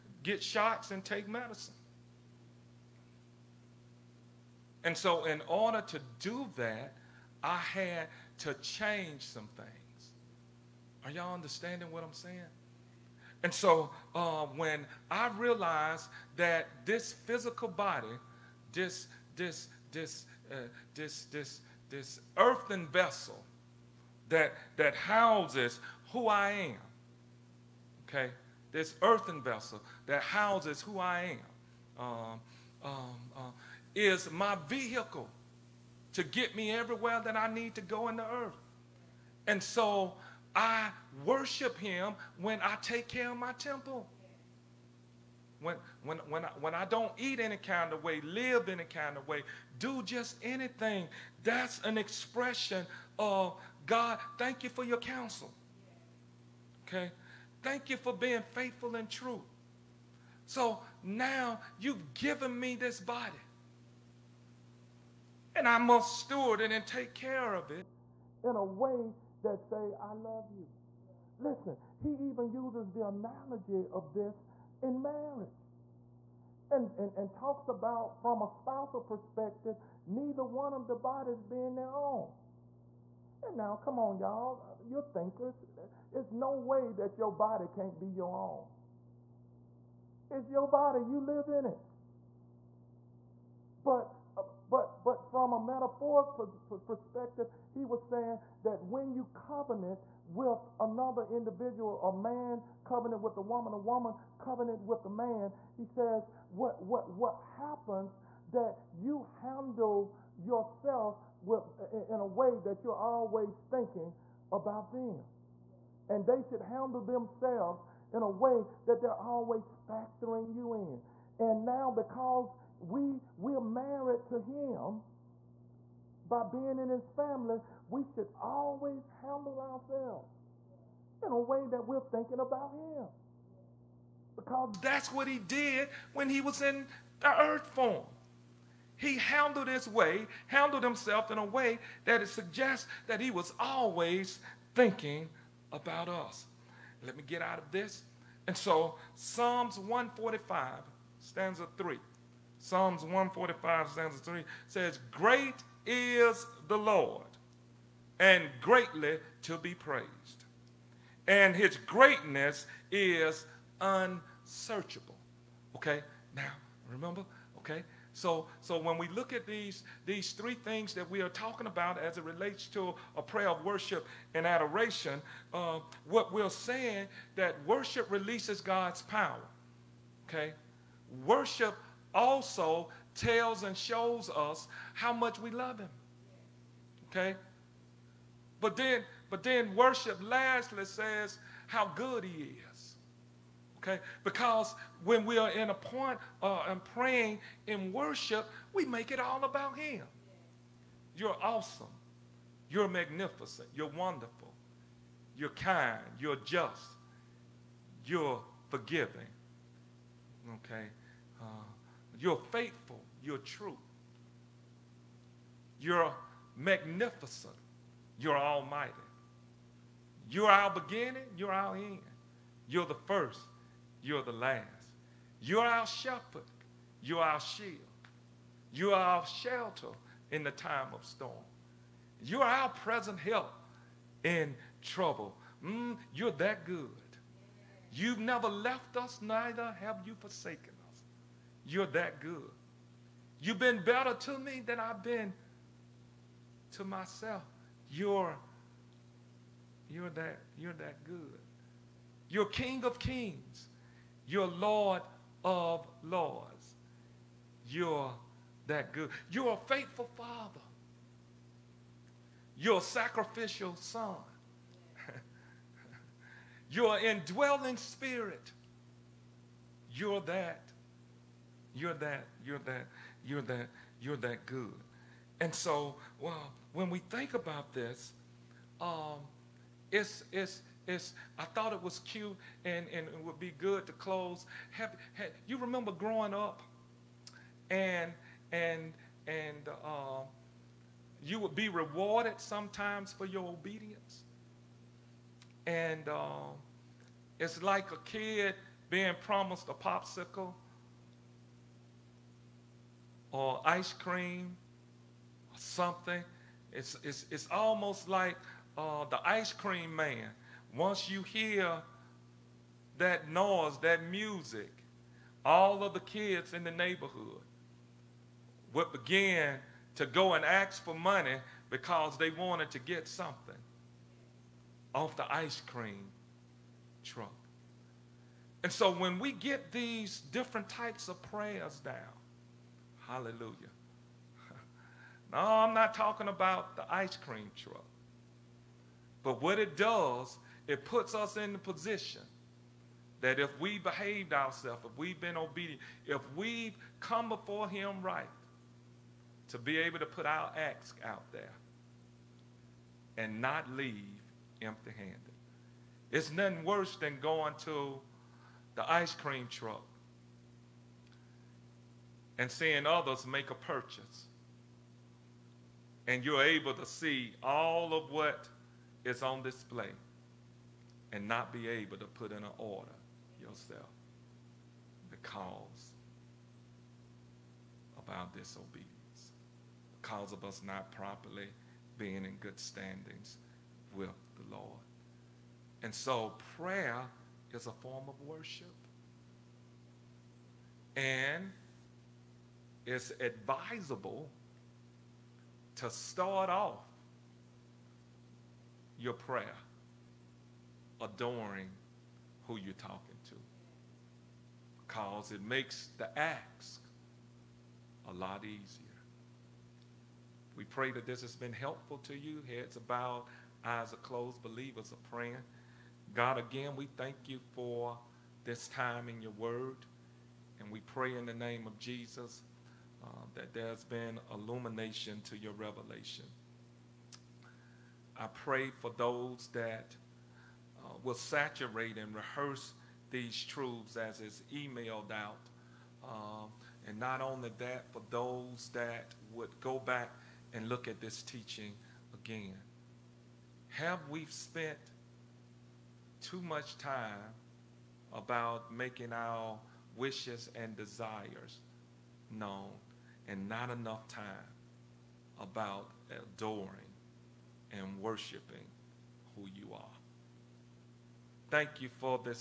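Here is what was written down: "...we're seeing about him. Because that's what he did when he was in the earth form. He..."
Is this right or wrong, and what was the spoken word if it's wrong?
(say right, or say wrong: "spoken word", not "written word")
wrong: "thinking", not "seeing".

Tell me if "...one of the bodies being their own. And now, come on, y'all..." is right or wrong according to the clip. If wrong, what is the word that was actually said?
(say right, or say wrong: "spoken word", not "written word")
right.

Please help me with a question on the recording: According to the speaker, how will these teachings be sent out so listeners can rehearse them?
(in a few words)
emailed.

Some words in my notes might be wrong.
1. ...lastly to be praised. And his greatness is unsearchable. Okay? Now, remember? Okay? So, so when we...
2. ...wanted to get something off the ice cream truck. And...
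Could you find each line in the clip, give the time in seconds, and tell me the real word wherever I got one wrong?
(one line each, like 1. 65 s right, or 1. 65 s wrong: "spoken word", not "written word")
1. 158 s wrong: "greatly", not "lastly"
2. 322 s right.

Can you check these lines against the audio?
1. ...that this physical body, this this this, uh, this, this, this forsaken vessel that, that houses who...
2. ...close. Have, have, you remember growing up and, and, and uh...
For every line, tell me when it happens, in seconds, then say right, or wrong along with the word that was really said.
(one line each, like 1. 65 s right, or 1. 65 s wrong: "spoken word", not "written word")
1. 16 s wrong: "earthen", not "forsaken"
2. 283 s right.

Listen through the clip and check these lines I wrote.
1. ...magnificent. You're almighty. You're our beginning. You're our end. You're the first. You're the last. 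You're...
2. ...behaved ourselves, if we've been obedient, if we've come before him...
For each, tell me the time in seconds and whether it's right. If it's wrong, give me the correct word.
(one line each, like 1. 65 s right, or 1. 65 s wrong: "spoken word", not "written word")
1. 216 s right
2. 343 s right.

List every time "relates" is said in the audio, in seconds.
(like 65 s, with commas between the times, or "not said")
172 s.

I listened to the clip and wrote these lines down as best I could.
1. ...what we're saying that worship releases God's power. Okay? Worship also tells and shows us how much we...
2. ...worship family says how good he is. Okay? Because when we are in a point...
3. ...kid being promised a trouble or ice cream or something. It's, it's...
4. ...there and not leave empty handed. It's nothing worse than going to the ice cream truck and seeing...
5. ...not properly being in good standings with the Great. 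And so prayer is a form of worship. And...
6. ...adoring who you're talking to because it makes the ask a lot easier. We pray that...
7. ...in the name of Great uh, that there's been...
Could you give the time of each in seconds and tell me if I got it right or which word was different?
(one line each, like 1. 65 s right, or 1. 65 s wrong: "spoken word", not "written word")
1. 176 s right
2. 189 s wrong: "lastly", not "family"
3. 298 s wrong: "popsicle", not "trouble"
4. 351 s right
5. 380 s wrong: "Lord", not "Great"
6. 401 s right
7. 421 s wrong: "Jesus", not "Great".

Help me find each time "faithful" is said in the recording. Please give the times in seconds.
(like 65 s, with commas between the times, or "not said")
58 s, 212 s, 259 s.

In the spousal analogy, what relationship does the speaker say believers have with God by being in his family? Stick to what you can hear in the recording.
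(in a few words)
married to him.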